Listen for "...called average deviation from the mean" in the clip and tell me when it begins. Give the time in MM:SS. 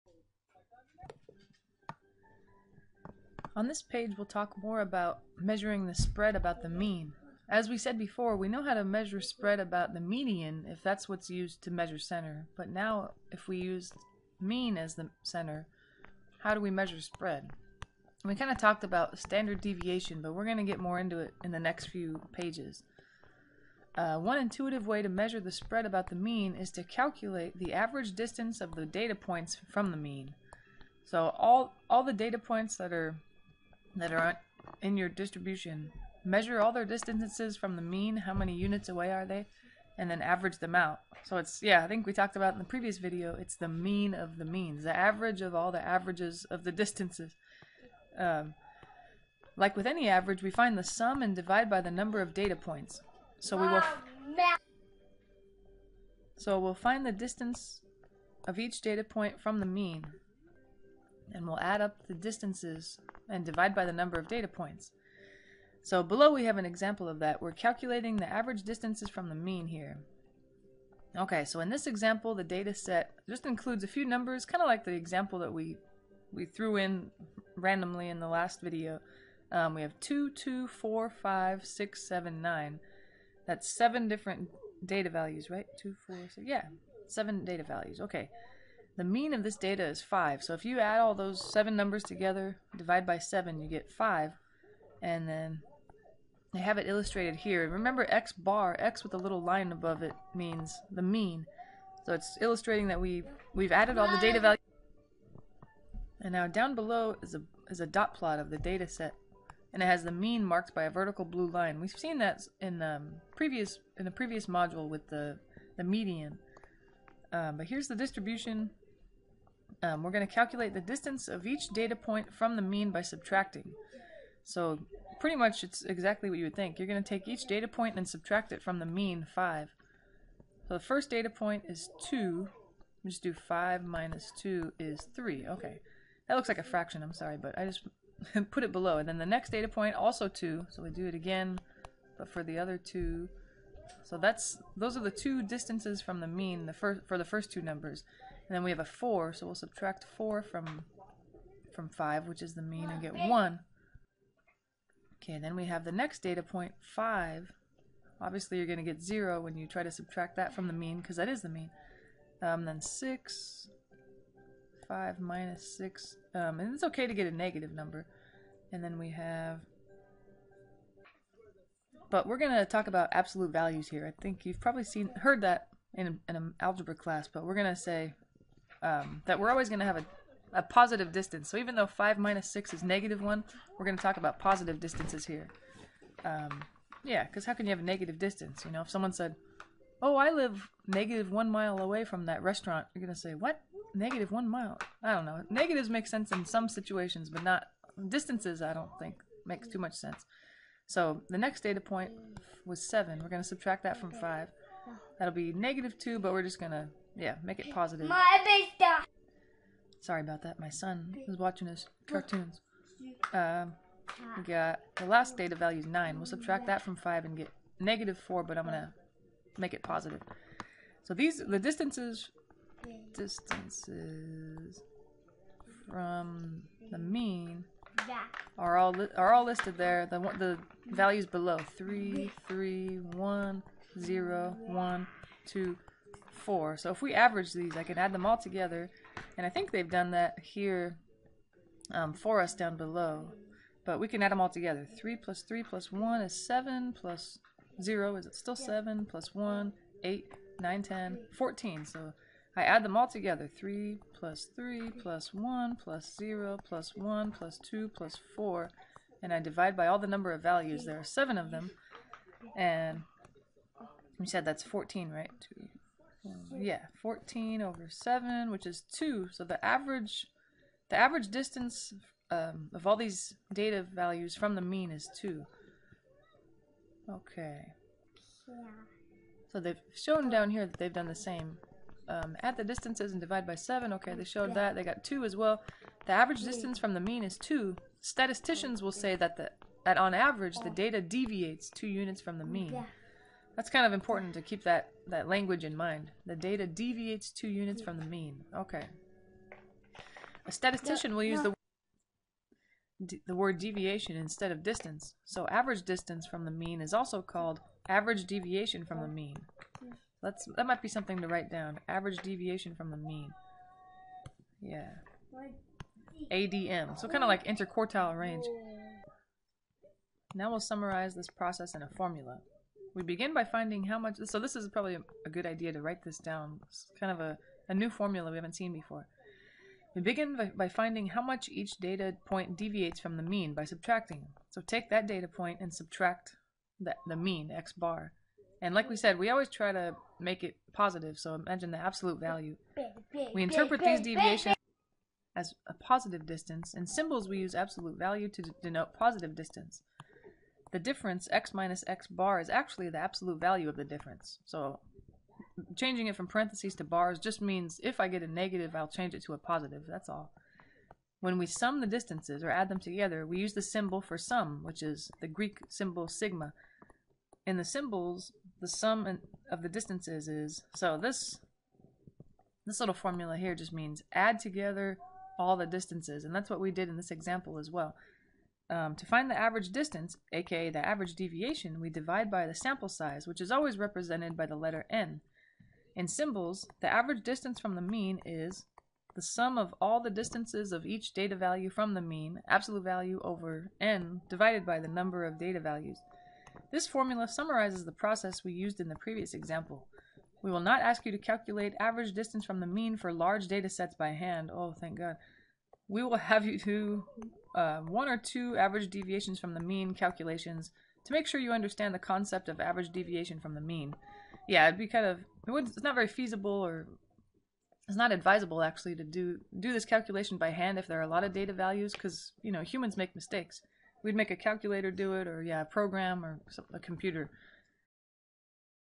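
05:07.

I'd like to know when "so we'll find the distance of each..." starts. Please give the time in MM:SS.
00:56.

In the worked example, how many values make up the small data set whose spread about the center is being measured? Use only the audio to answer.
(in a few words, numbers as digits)
7.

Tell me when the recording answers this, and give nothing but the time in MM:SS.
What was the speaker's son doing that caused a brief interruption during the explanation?
03:31.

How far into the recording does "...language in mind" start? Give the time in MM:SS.
04:55.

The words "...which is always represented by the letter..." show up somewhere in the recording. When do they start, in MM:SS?
06:23.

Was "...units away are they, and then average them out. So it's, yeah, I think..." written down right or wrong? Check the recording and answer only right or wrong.
right.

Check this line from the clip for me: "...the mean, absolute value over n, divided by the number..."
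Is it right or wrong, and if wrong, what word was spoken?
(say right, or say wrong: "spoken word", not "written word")
right.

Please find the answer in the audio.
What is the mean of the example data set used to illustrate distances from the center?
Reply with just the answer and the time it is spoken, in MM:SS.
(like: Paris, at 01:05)
5, at 01:28.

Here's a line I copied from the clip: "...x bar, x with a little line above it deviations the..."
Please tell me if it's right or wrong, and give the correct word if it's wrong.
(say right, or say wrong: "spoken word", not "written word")
wrong: "means", not "deviations".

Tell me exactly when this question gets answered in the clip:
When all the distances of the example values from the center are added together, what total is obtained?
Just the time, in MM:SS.
04:11.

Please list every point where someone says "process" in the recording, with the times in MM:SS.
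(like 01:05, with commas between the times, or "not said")
05:21, 06:37.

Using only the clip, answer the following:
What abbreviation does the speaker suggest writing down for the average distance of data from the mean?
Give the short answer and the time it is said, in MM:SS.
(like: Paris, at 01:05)
ADM, at 05:16.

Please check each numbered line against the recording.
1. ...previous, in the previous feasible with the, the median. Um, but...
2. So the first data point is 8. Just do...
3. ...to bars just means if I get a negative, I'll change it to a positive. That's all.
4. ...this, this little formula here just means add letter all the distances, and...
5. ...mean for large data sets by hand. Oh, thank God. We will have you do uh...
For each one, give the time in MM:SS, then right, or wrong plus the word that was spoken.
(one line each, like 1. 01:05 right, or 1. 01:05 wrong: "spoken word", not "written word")
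1. 01:53 wrong: "module", not "feasible"
2. 02:10 wrong: "2", not "8"
3. 05:56 right
4. 06:10 wrong: "together", not "letter"
5. 06:42 right.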